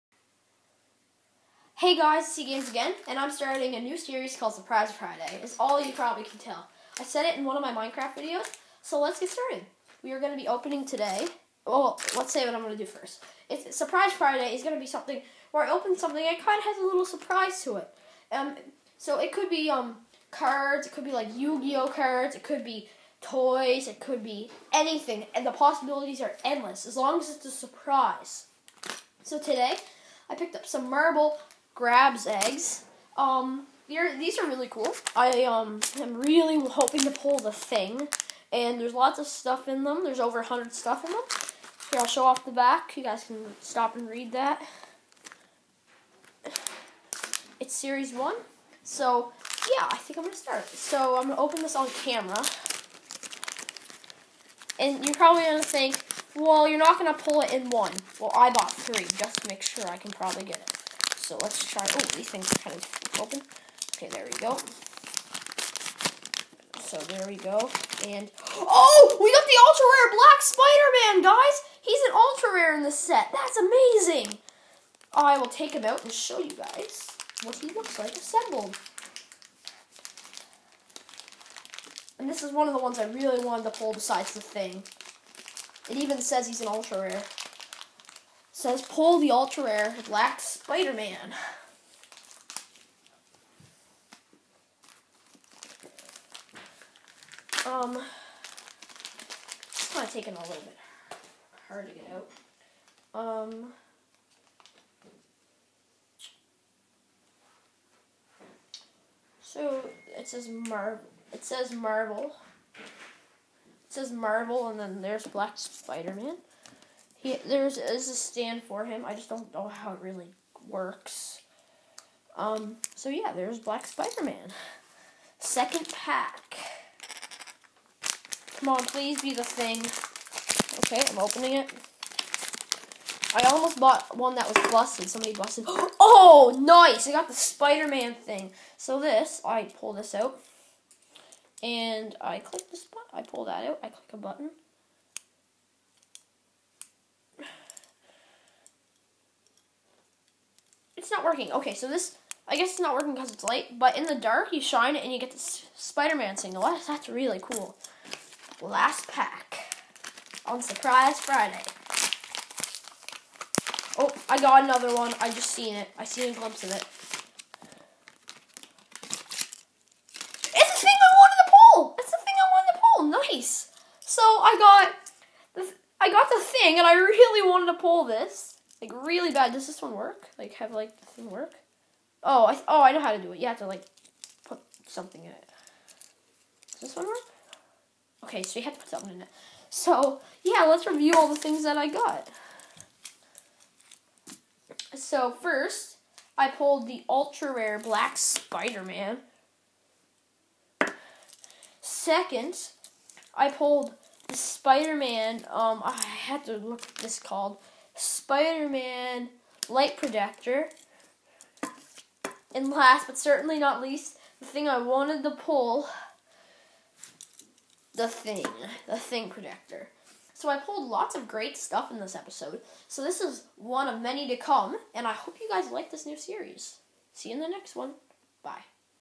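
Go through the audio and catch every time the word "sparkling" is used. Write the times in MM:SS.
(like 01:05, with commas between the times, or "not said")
not said.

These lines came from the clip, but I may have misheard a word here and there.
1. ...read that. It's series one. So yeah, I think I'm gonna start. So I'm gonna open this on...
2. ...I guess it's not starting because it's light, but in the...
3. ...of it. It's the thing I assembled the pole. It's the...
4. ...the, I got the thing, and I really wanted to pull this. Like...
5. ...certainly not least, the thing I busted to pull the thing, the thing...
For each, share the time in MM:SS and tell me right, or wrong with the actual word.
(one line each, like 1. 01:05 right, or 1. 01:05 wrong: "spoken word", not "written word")
1. 00:44 right
2. 02:32 wrong: "working", not "starting"
3. 02:46 wrong: "wanted", not "assembled"
4. 02:55 right
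5. 03:33 wrong: "wanted", not "busted".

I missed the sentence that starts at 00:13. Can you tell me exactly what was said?
It's Surprise Friday is going to be something where I open something that kind of has a little surprise to it.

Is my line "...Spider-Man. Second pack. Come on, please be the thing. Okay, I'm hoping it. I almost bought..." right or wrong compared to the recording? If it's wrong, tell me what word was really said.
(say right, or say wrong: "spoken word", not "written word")
wrong: "opening", not "hoping".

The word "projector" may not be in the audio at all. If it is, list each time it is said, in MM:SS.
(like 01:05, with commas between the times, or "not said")
03:29, 03:39.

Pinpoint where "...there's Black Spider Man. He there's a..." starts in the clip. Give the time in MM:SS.
01:55.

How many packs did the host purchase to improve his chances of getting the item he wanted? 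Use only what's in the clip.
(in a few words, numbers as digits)
3.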